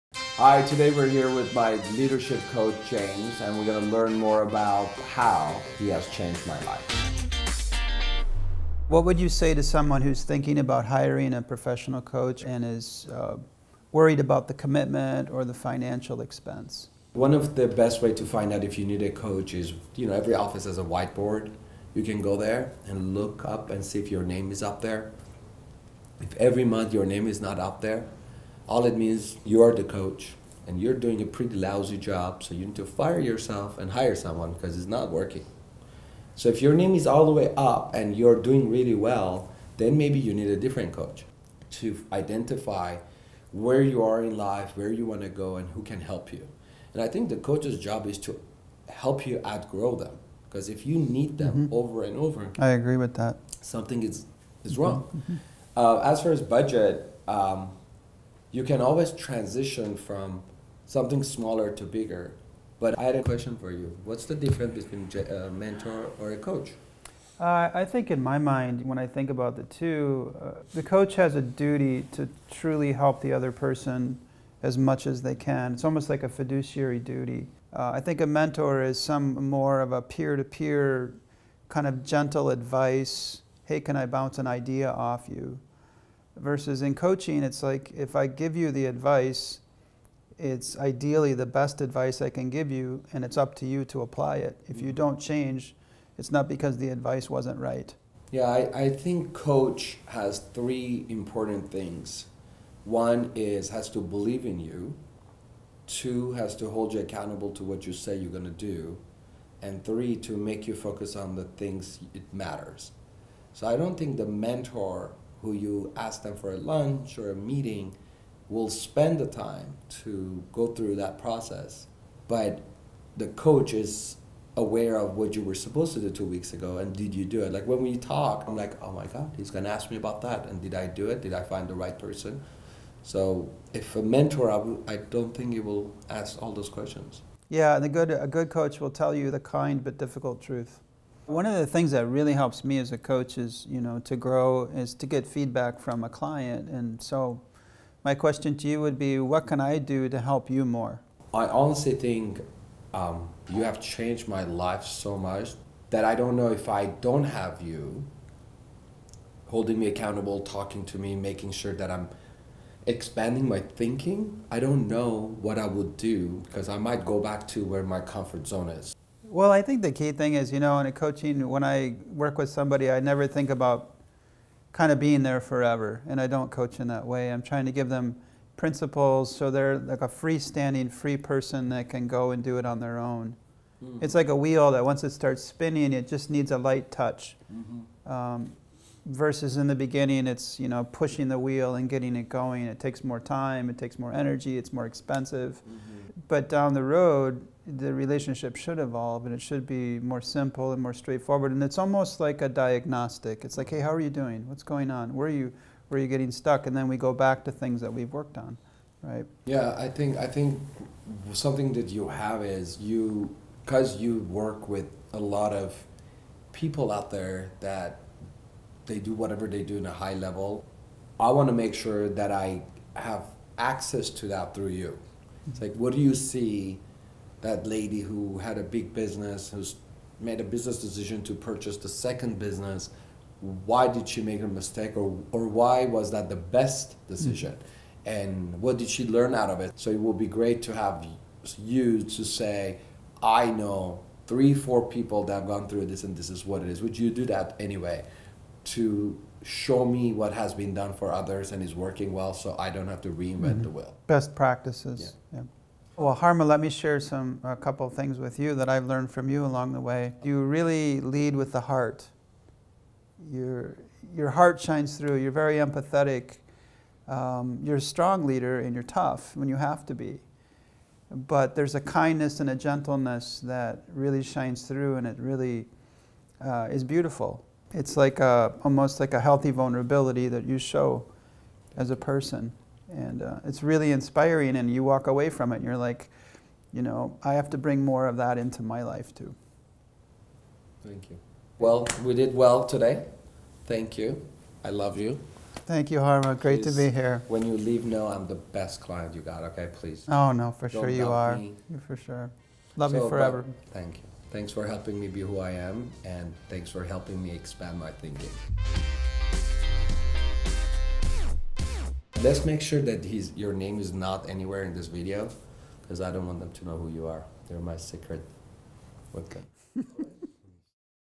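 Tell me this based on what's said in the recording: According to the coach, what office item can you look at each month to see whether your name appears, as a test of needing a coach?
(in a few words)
whiteboard.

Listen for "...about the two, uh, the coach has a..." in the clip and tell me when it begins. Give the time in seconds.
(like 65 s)
69 s.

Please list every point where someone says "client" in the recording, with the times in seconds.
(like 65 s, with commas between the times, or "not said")
146 s, 298 s.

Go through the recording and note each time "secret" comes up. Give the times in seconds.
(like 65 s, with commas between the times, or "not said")
317 s.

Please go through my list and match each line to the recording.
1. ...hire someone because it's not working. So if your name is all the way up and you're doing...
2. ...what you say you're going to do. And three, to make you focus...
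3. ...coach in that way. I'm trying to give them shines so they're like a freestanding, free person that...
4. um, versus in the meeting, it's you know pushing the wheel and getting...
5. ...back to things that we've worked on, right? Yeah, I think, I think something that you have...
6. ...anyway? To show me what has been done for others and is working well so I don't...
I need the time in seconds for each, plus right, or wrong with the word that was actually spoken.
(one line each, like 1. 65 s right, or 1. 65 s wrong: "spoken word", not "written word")
1. 33 s right
2. 107 s right
3. 176 s wrong: "principles", not "shines"
4. 188 s wrong: "beginning", not "meeting"
5. 207 s right
6. 247 s right.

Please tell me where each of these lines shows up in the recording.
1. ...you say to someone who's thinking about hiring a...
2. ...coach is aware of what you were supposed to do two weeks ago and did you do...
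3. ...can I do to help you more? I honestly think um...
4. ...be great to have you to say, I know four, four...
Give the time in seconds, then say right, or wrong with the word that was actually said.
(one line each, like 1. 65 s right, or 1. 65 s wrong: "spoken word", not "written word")
1. 9 s right
2. 123 s right
3. 149 s right
4. 240 s wrong: "three", not "four".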